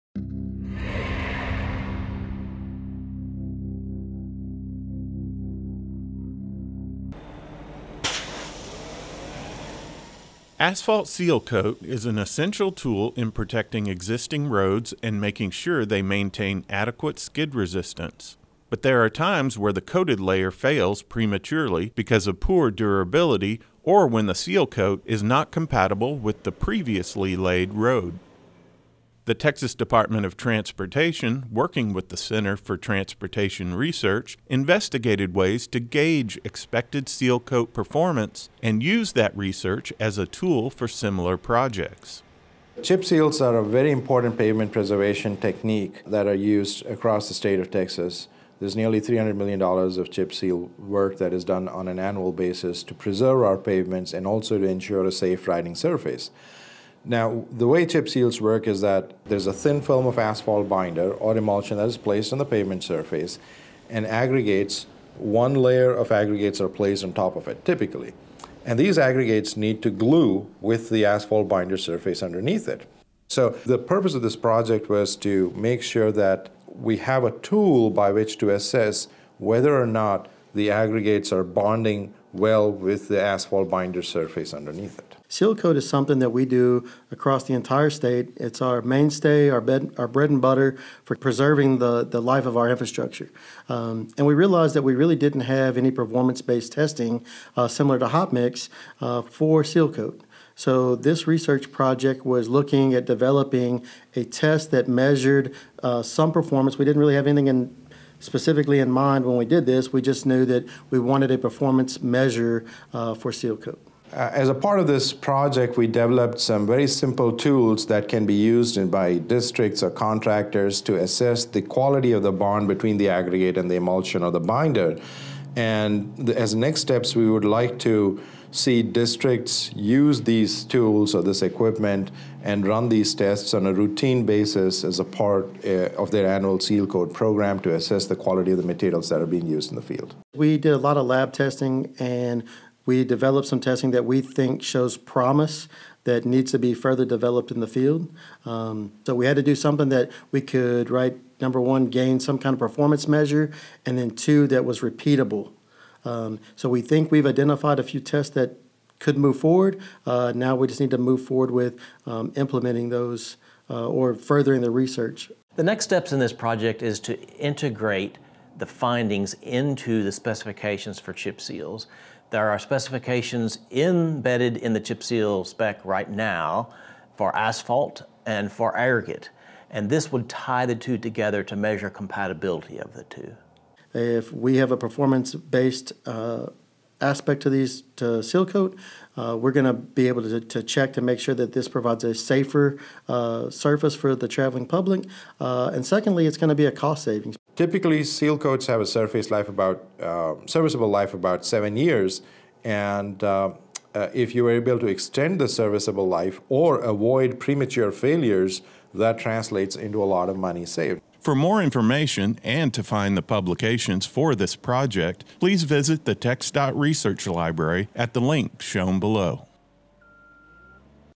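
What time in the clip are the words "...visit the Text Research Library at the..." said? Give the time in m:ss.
3:35.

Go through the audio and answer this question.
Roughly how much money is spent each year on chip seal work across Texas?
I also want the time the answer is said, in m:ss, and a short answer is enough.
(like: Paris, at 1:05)
$300 million, at 0:48.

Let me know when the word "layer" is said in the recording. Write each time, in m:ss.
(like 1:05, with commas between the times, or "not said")
0:20, 1:05.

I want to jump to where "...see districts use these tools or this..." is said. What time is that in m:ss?
2:08.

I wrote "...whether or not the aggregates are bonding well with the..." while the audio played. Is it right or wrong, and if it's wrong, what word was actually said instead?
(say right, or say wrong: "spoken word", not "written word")
right.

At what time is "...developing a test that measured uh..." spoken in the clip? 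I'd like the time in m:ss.
1:43.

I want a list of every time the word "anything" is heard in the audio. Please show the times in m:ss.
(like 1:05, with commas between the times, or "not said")
1:47.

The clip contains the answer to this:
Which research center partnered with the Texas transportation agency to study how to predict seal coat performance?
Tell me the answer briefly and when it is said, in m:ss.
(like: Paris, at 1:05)
Center for Transportation Research, at 0:32.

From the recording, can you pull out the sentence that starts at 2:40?
Uh, now we just need to move forward with um, implementing those uh, or furthering the research.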